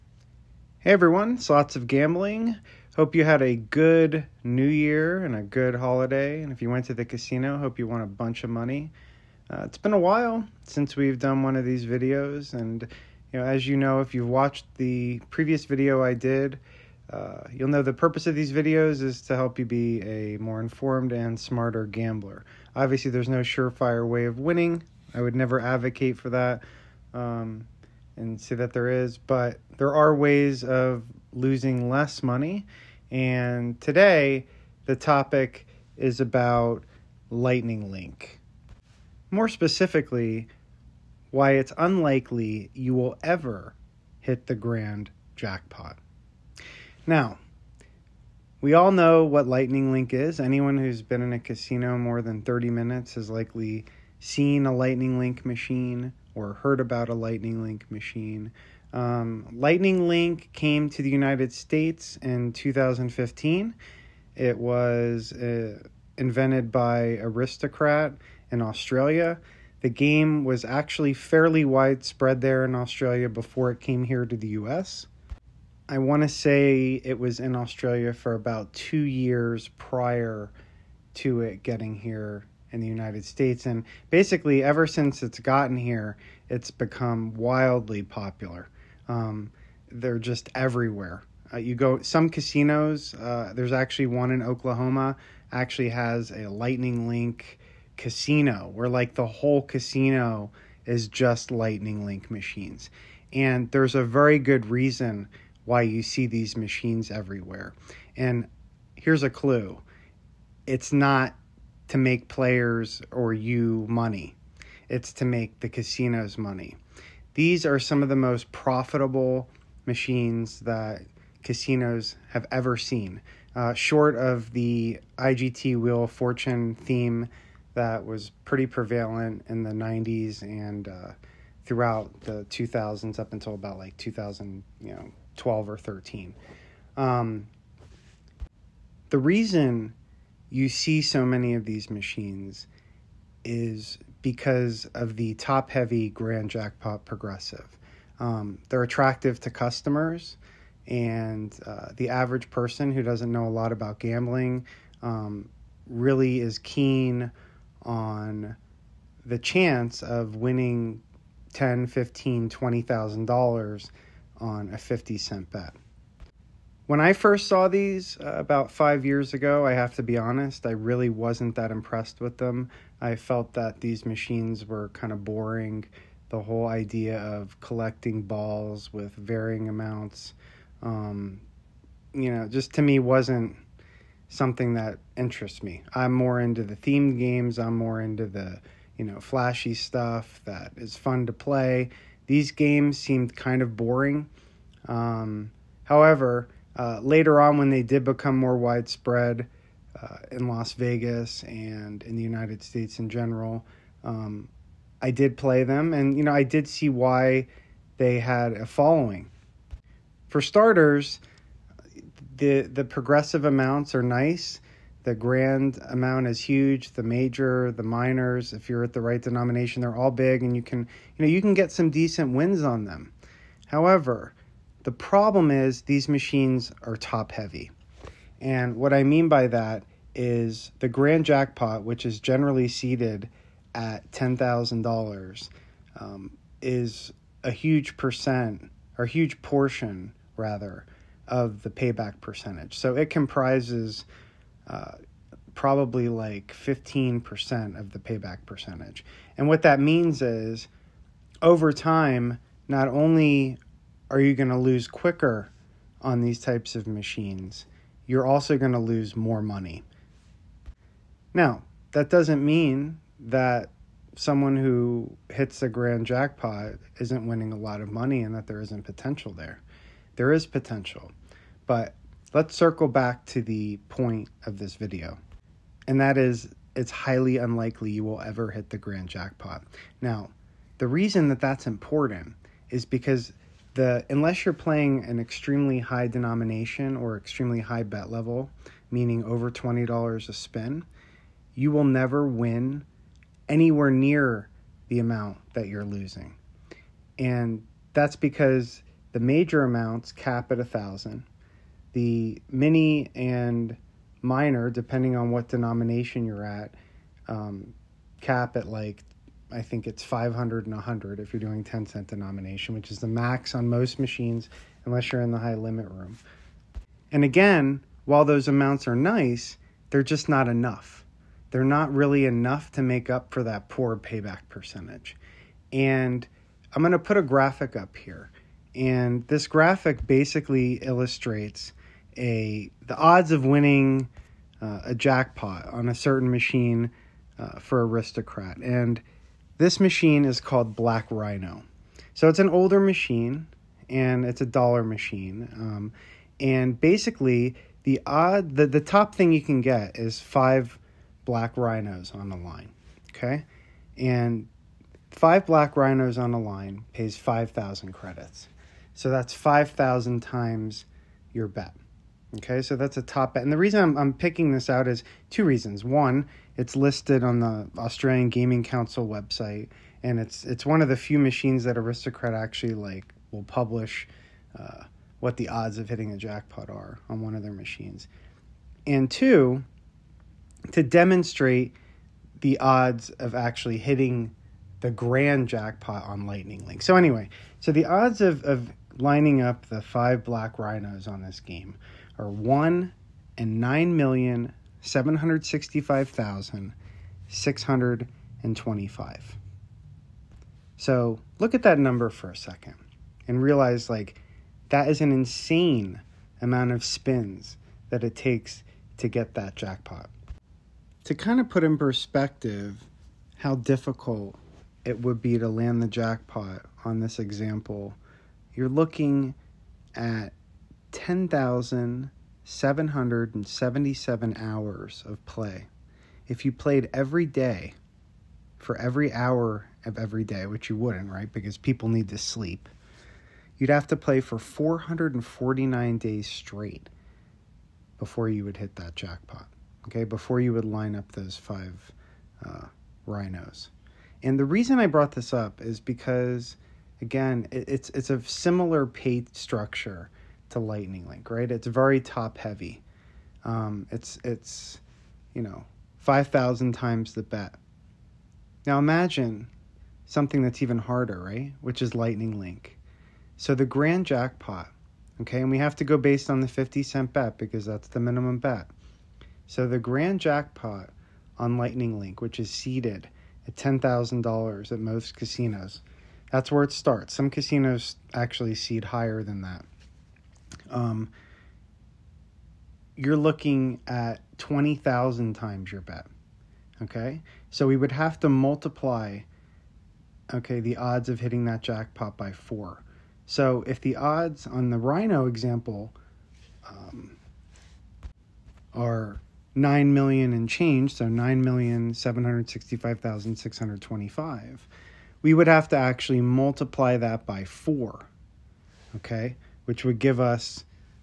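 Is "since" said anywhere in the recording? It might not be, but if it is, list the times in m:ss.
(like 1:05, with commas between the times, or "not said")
0:10, 1:24.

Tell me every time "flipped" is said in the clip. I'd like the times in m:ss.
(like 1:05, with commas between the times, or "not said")
not said.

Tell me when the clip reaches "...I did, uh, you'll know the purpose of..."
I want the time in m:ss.
0:16.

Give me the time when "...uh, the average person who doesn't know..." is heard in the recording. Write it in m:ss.
2:31.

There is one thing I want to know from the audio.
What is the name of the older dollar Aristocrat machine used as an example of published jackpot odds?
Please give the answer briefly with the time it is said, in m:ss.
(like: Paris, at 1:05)
Black Rhino, at 5:40.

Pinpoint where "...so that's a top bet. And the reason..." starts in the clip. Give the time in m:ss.
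6:02.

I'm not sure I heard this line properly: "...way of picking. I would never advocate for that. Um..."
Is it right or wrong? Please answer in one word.
wrong.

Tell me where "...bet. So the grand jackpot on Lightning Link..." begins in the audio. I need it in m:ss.
7:48.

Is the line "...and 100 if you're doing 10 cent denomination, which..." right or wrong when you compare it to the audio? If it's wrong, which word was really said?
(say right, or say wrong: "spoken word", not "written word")
right.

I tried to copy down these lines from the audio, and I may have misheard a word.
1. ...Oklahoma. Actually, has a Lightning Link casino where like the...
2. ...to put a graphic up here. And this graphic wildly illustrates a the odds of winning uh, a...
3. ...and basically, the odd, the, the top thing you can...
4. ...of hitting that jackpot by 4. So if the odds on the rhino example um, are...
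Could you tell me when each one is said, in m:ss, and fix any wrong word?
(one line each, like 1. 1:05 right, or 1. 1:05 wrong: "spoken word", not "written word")
1. 1:34 right
2. 5:26 wrong: "basically", not "wildly"
3. 5:46 right
4. 8:11 right.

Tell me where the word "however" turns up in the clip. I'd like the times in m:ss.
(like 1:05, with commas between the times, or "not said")
3:15, 3:43.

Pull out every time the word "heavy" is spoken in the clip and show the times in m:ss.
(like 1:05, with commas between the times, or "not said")
2:25, 3:47, 7:32.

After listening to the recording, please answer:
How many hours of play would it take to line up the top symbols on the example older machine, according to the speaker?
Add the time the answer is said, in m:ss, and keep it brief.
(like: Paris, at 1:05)
10,777, at 7:00.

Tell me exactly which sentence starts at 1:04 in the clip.
It was uh, invented by Aristocrat in Australia.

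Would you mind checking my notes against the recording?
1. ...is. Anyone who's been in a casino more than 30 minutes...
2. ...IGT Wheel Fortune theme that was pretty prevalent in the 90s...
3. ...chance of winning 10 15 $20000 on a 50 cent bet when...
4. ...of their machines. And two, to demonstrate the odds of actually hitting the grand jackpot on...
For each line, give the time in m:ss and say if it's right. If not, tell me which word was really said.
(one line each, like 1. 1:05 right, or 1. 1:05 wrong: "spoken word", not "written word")
1. 0:50 right
2. 2:05 right
3. 2:39 right
4. 6:17 right.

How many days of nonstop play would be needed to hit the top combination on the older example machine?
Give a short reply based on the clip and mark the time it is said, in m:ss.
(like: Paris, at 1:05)
449, at 7:14.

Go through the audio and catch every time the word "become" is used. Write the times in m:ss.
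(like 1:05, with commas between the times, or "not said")
1:26, 3:18.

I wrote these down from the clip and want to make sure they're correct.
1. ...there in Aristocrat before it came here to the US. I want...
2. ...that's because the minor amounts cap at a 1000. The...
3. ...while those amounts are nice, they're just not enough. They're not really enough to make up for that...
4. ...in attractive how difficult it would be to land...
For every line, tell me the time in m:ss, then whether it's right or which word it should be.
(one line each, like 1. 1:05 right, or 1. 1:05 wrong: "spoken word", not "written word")
1. 1:12 wrong: "Australia", not "Aristocrat"
2. 4:57 wrong: "major", not "minor"
3. 5:18 right
4. 6:51 wrong: "perspective", not "attractive".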